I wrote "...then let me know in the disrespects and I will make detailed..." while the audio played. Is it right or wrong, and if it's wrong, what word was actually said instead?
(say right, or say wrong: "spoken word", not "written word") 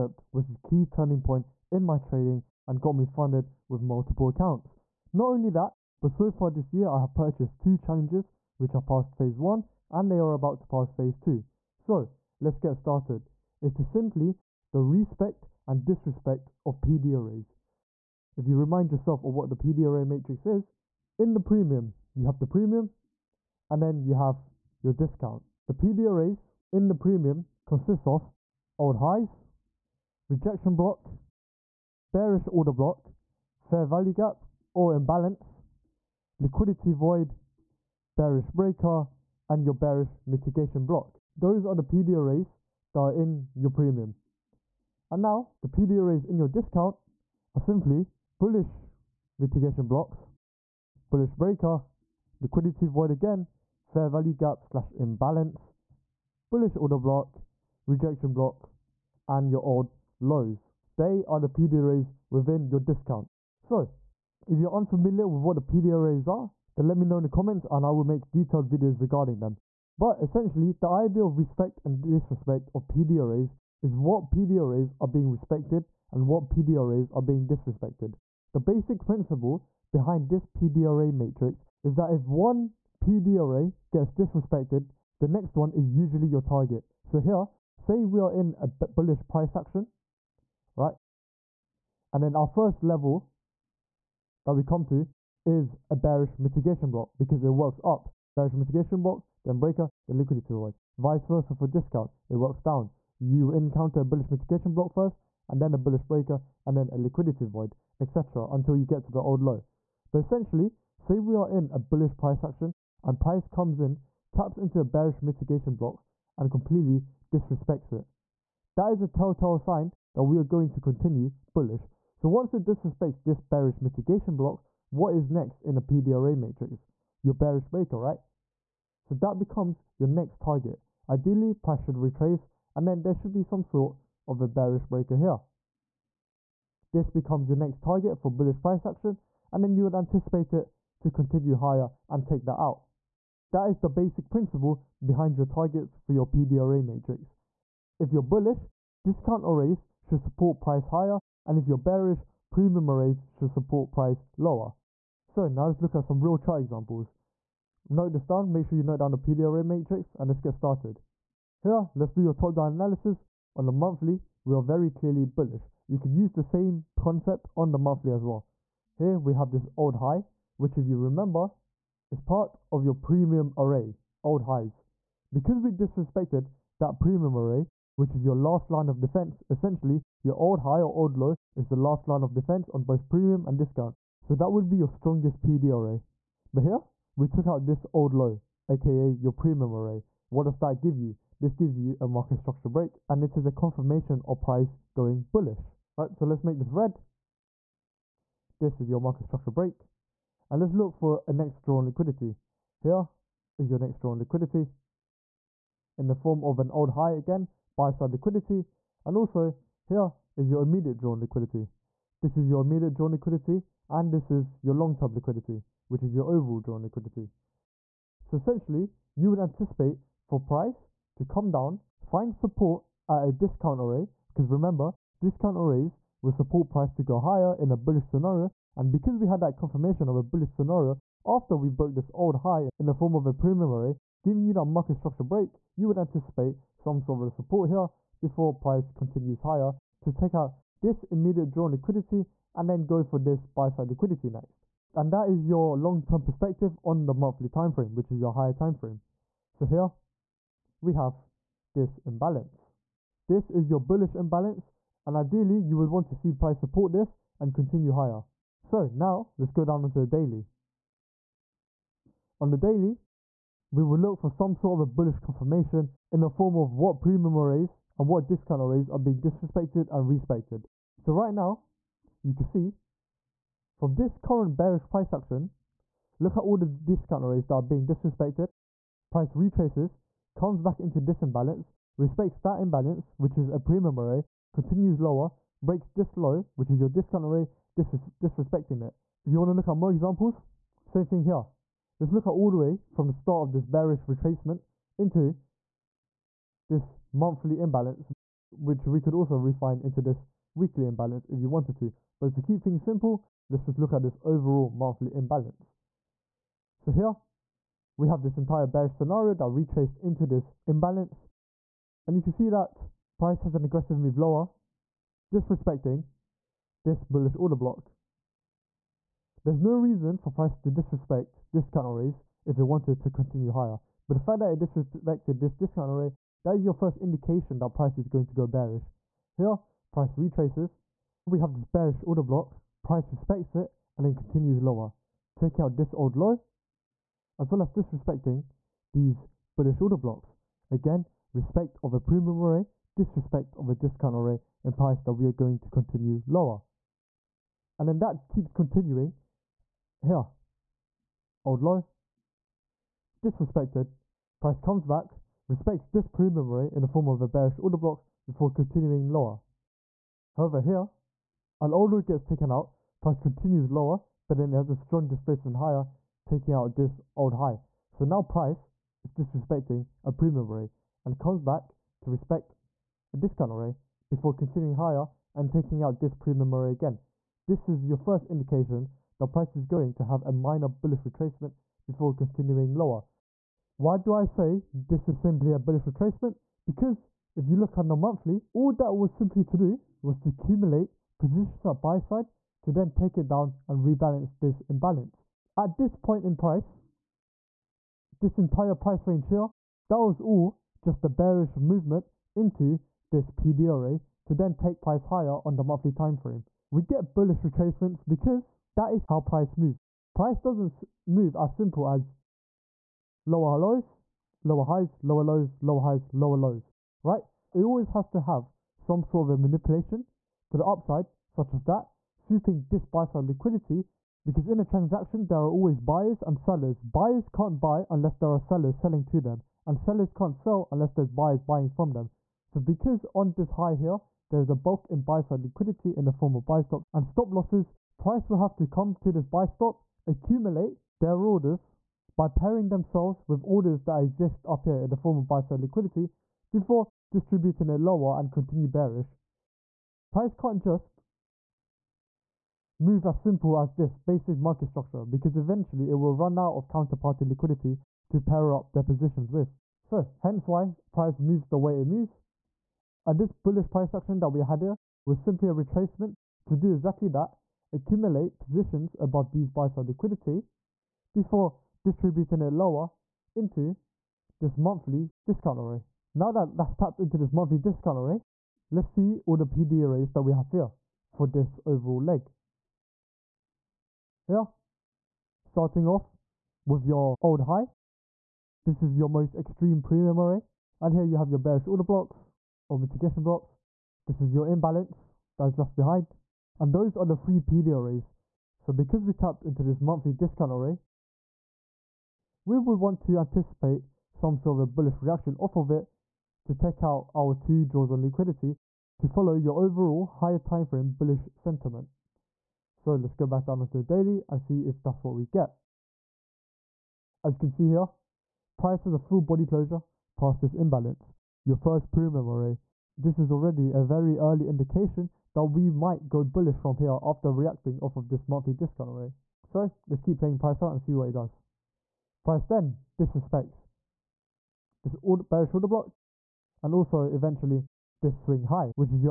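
wrong: "comments", not "disrespects".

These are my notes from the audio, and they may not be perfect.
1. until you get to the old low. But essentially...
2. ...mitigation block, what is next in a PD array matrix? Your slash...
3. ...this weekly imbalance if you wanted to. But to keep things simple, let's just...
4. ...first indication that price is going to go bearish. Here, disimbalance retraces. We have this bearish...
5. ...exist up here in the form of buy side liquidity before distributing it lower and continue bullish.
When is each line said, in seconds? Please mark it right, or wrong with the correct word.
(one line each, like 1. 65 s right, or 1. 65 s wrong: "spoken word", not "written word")
1. 108 s right
2. 123 s wrong: "bearish", not "slash"
3. 300 s right
4. 326 s wrong: "price", not "disimbalance"
5. 444 s wrong: "bearish", not "bullish".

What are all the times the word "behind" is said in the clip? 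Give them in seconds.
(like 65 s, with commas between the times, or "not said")
79 s, 145 s, 495 s.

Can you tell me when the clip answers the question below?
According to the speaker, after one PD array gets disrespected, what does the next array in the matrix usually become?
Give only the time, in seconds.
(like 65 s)
86 s.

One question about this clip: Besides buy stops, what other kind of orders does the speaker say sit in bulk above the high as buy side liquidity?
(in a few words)
Stop losses.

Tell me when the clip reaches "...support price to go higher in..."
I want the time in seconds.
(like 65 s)
226 s.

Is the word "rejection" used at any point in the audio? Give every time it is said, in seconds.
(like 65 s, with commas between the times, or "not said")
30 s, 57 s.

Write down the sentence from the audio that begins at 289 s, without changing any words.
If you want to look at more examples, same thing here.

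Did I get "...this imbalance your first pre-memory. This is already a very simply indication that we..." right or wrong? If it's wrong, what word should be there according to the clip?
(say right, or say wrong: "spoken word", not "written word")
wrong: "early", not "simply".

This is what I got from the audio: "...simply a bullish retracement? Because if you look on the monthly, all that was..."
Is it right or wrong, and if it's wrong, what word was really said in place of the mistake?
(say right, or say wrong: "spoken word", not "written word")
right.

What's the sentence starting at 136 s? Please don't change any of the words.
This becomes your next target for bullish price action, and then you would anticipate it to continue higher and take that out.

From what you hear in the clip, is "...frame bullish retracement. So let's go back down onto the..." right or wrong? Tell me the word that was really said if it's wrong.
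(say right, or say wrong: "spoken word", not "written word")
wrong: "sentiment", not "retracement".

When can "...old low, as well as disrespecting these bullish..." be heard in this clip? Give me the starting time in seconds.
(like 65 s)
335 s.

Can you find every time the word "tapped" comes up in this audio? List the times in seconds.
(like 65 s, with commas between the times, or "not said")
476 s, 499 s.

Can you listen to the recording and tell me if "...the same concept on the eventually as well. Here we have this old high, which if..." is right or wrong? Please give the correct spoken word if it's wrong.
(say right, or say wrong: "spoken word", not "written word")
wrong: "monthly", not "eventually".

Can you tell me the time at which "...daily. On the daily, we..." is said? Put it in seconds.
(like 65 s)
260 s.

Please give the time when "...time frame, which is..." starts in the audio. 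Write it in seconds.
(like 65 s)
247 s.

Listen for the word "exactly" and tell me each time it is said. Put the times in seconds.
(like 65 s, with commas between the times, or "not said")
466 s.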